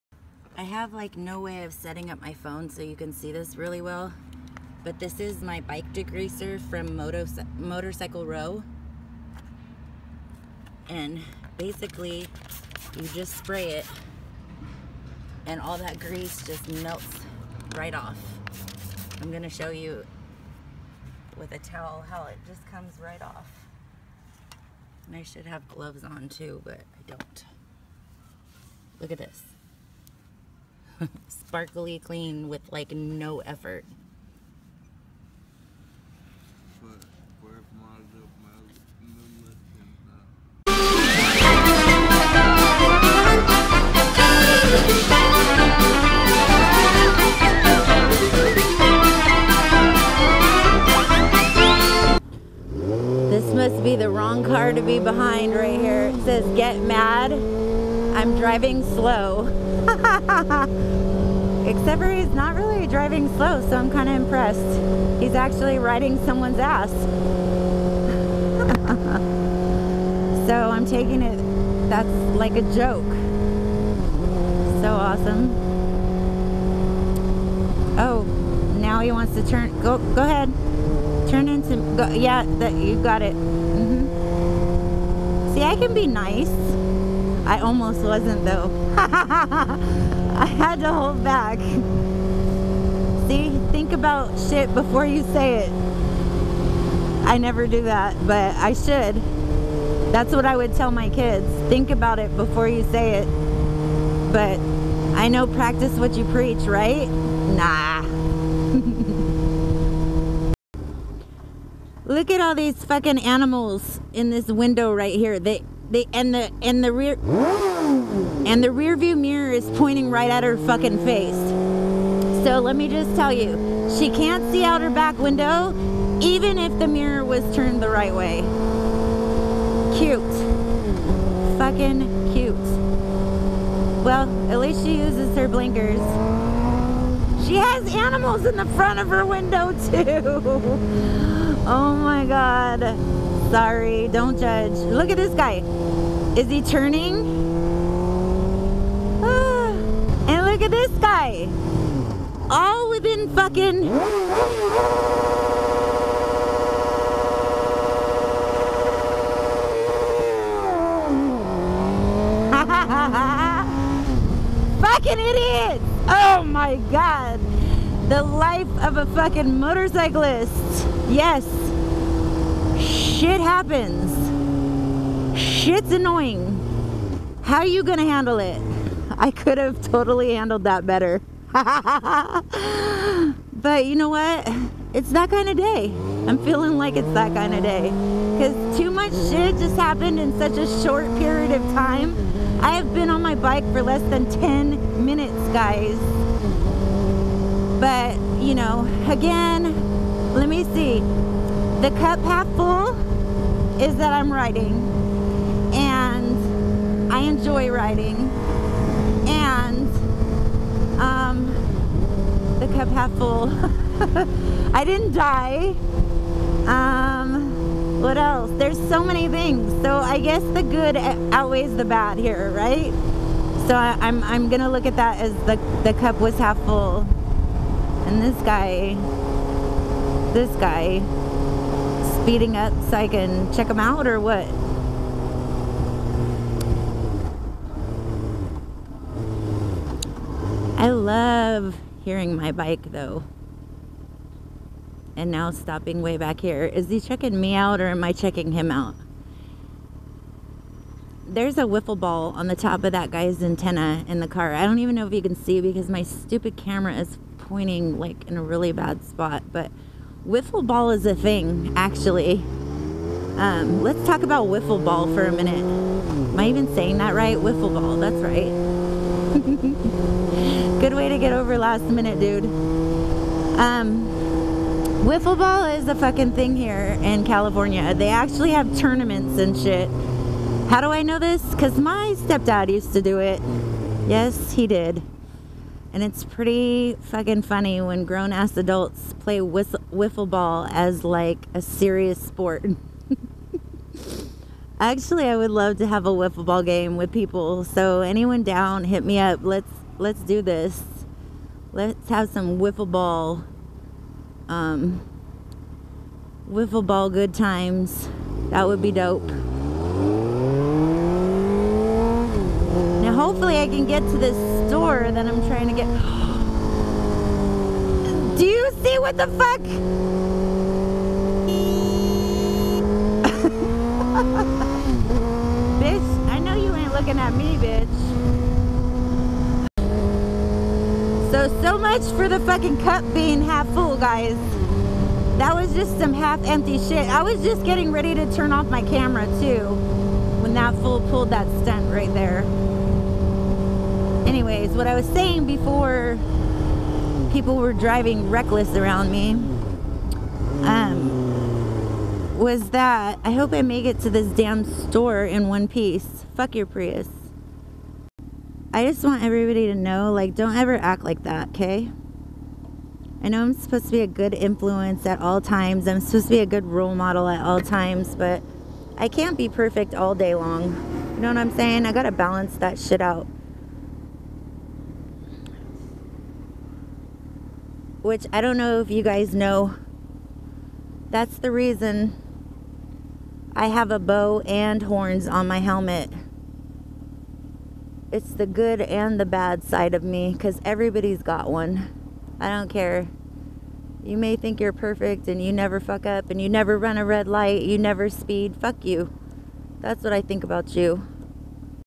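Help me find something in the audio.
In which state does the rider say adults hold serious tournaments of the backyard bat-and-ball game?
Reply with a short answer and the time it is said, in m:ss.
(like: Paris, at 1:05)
California, at 4:37.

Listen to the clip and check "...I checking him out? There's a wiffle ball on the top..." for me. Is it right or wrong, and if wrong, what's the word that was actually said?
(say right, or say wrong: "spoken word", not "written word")
right.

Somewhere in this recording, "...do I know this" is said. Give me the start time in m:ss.
4:40.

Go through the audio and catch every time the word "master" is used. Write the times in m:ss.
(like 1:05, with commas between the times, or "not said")
not said.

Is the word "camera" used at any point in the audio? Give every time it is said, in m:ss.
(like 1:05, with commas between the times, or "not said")
4:16, 5:38.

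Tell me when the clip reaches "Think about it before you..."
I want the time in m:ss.
1:41.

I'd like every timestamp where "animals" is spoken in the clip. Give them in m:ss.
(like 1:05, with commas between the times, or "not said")
1:53, 2:17.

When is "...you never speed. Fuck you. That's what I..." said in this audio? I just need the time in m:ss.
6:37.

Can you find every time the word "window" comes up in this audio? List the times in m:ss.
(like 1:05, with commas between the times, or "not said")
1:54, 2:05, 2:19.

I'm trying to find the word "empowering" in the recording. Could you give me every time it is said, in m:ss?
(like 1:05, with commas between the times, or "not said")
not said.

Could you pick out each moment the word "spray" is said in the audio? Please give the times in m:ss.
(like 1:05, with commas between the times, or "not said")
0:13.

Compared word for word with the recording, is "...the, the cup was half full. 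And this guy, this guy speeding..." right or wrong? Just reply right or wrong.
right.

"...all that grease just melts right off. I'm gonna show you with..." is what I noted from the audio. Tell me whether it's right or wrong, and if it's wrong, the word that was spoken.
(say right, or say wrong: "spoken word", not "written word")
right.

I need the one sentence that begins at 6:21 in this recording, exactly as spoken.
That's the reason I have a bow and horns on my helmet.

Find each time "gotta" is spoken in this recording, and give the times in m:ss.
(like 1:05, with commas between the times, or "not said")
6:11.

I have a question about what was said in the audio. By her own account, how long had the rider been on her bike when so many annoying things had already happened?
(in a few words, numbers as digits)
less than 10 minutes.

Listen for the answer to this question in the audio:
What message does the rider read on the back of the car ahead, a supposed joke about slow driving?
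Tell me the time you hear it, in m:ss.
0:56.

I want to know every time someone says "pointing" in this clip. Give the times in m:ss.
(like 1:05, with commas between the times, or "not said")
1:59, 4:17.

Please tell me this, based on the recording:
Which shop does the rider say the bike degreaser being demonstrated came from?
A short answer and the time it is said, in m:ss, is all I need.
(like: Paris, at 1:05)
Moto Motorcycle Row, at 0:06.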